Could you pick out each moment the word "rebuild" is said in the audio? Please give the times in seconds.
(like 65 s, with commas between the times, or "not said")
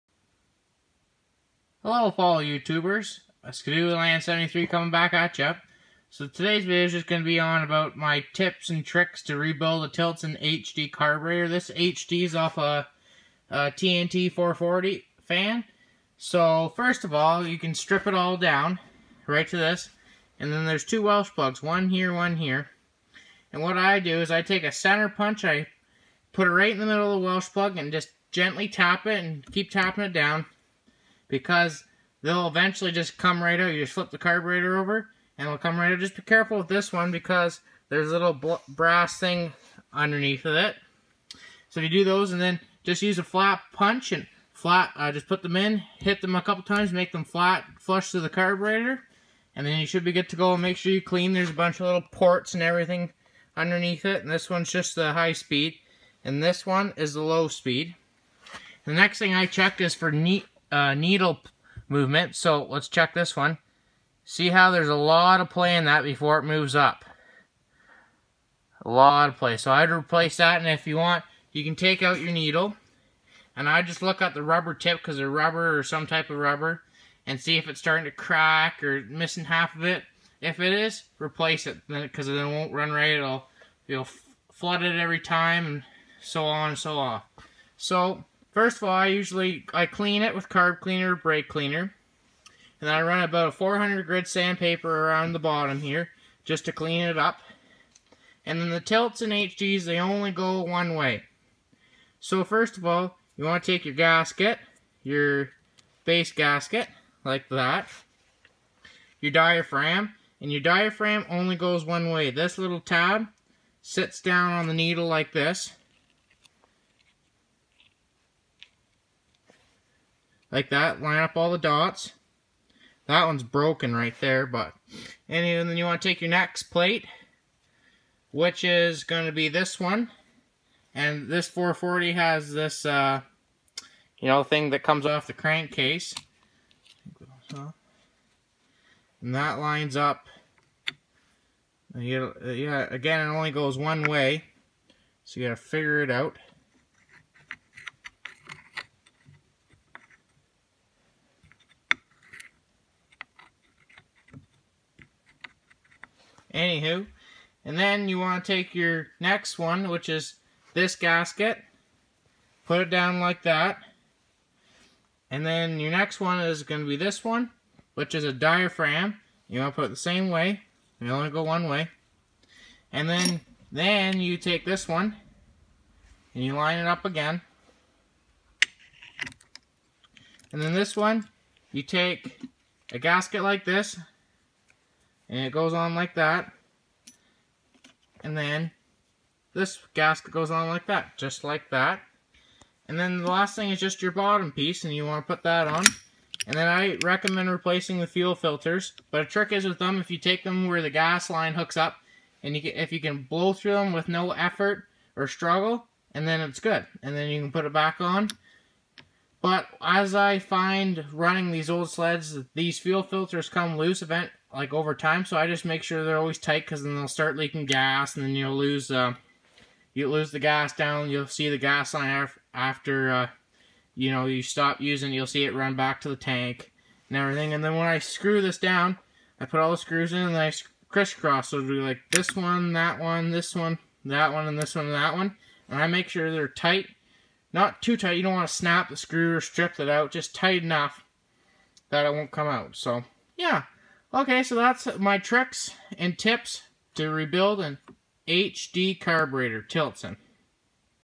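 9 s, 247 s.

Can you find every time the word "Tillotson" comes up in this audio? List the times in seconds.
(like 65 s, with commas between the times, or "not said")
9 s, 98 s, 249 s.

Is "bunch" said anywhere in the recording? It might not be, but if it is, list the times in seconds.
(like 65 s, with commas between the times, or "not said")
51 s.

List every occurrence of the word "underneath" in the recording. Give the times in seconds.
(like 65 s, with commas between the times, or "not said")
39 s, 53 s.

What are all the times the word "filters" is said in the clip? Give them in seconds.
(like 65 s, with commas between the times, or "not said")
198 s, 213 s.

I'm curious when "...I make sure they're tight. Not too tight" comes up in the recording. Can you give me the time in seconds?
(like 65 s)
235 s.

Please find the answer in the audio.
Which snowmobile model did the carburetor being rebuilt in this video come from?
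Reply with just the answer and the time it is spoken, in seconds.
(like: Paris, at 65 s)
TNT 440, at 13 s.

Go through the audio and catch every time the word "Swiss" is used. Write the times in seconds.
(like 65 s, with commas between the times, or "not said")
not said.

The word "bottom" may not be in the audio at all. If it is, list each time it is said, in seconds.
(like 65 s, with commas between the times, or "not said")
95 s, 194 s.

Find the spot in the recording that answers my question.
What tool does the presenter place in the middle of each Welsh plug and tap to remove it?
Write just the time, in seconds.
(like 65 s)
24 s.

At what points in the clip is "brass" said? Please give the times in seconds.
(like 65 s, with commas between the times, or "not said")
38 s.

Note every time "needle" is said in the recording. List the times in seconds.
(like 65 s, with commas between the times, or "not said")
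60 s, 72 s, 114 s.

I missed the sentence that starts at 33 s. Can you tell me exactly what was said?
You just flip the carburetor over and it'll come right out.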